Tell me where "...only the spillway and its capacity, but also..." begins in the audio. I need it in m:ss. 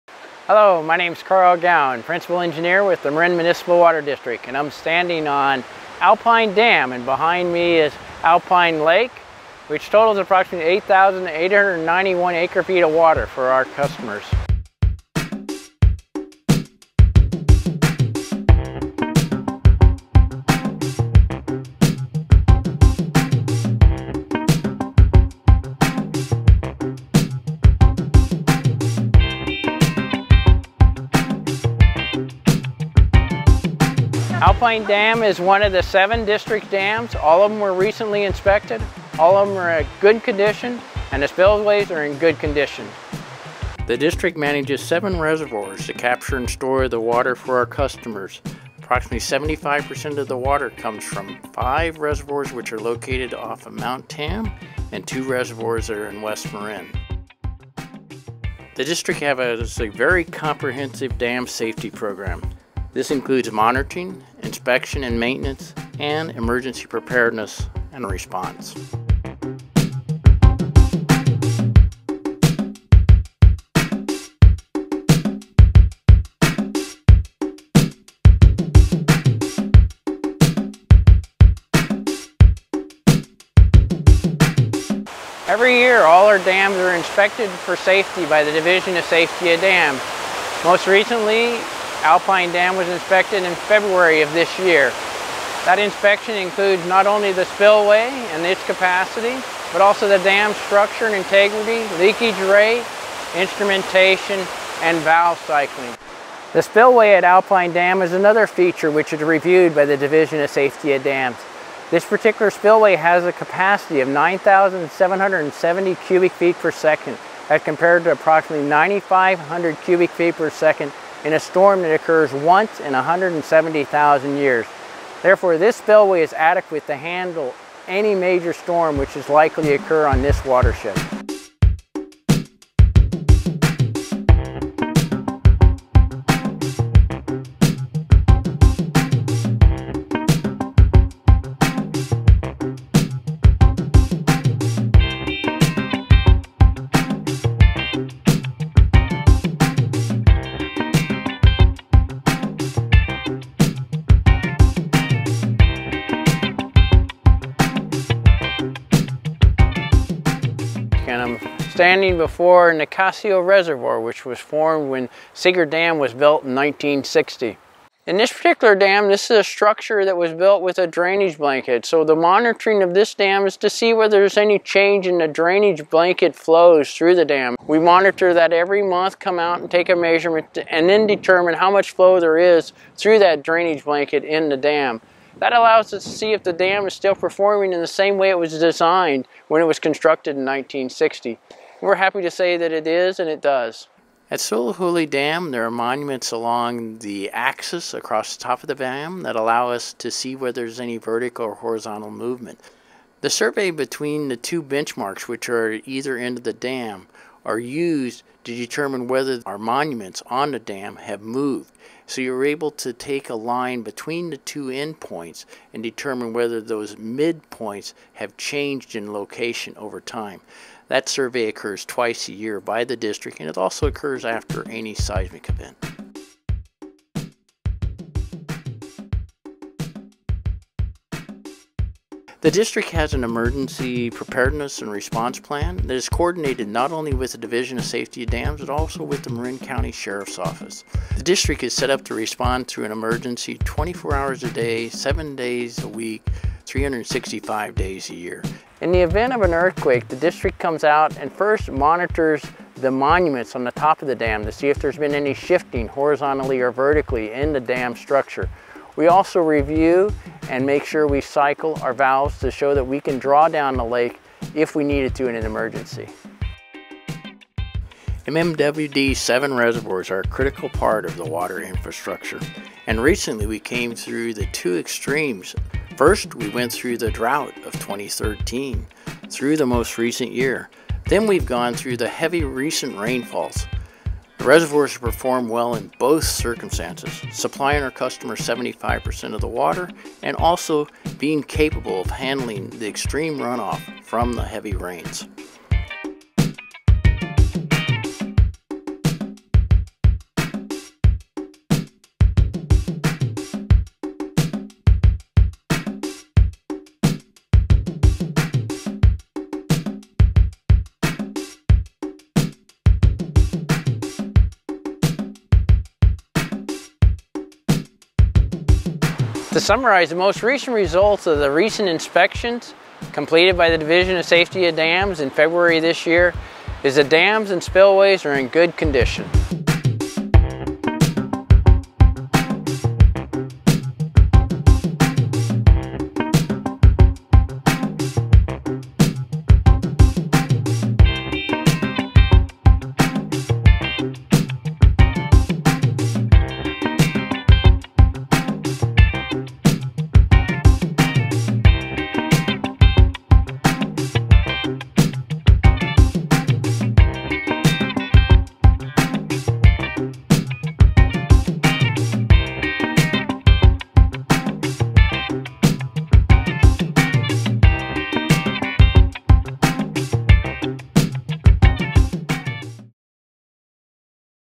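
1:37.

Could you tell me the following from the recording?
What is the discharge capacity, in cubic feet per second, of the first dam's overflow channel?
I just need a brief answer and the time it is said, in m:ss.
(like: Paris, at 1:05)
9,770, at 1:54.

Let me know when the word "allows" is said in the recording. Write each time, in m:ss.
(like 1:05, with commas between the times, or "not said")
3:05, 3:19.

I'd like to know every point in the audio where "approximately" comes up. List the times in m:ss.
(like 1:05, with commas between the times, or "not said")
0:10, 0:48, 1:58.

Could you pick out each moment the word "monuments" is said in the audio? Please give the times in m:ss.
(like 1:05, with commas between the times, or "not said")
3:15, 3:29, 4:12.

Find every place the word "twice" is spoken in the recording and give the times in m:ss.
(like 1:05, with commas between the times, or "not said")
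3:41.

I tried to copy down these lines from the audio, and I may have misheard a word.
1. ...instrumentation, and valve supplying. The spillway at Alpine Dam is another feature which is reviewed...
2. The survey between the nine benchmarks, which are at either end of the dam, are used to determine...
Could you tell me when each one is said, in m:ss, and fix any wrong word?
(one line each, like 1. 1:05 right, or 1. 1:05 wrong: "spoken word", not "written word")
1. 1:43 wrong: "cycling", not "supplying"
2. 3:23 wrong: "two", not "nine".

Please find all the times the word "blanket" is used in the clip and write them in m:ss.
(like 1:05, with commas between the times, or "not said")
2:51, 2:55, 3:03.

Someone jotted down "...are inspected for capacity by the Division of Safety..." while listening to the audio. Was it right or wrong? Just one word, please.
wrong.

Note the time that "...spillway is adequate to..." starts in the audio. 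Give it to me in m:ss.
2:05.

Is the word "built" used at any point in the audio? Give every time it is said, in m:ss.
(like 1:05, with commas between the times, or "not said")
2:46, 2:50.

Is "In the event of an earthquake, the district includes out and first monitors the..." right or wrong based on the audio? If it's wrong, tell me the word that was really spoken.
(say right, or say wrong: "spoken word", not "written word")
wrong: "comes", not "includes".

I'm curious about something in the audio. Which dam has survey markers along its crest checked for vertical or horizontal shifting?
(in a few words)
Soulajule Dam.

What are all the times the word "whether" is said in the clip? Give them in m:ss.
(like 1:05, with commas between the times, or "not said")
2:53, 3:20, 3:29, 3:36.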